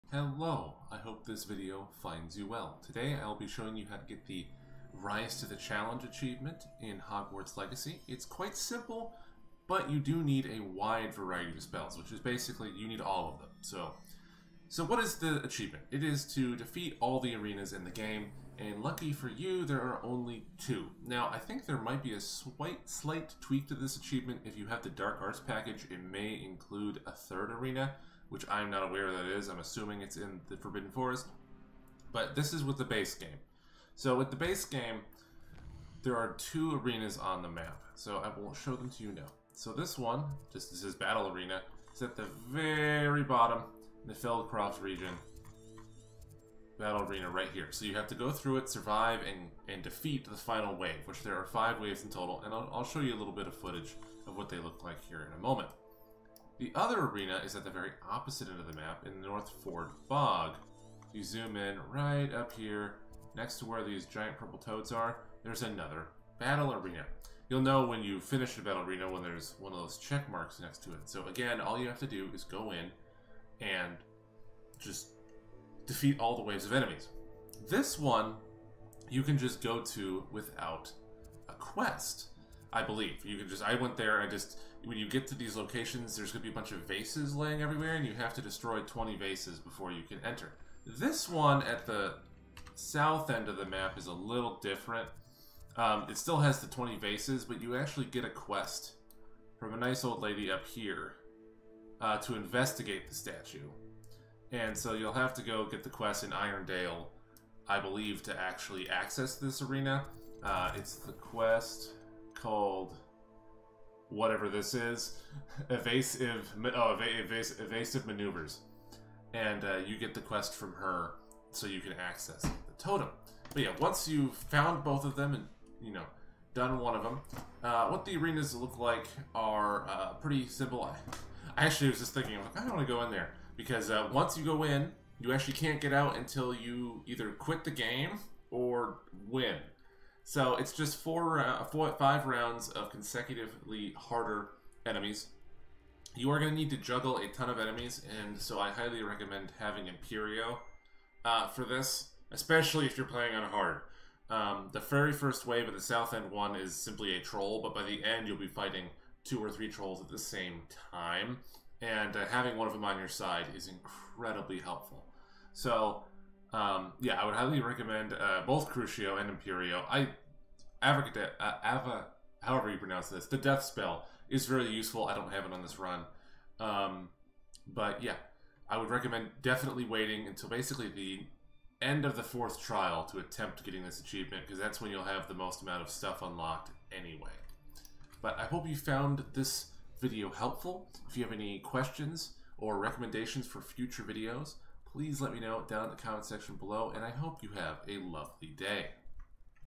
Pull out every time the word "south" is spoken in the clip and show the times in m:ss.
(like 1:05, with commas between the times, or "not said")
1:32, 2:35.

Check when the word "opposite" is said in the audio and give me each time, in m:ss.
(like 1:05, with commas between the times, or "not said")
0:58.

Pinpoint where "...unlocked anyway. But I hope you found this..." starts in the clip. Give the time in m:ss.
3:06.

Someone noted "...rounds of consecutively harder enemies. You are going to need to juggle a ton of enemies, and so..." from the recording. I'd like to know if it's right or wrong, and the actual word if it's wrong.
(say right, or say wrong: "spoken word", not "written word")
right.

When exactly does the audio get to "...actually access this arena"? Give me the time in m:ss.
1:48.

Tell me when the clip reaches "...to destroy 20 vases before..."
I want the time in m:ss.
1:28.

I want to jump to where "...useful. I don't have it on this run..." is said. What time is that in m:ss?
2:54.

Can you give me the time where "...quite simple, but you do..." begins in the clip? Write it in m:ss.
0:08.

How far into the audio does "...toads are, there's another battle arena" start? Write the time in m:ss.
1:04.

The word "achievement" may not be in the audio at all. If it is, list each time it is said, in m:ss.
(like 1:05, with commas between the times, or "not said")
0:06, 0:15, 0:23, 3:03.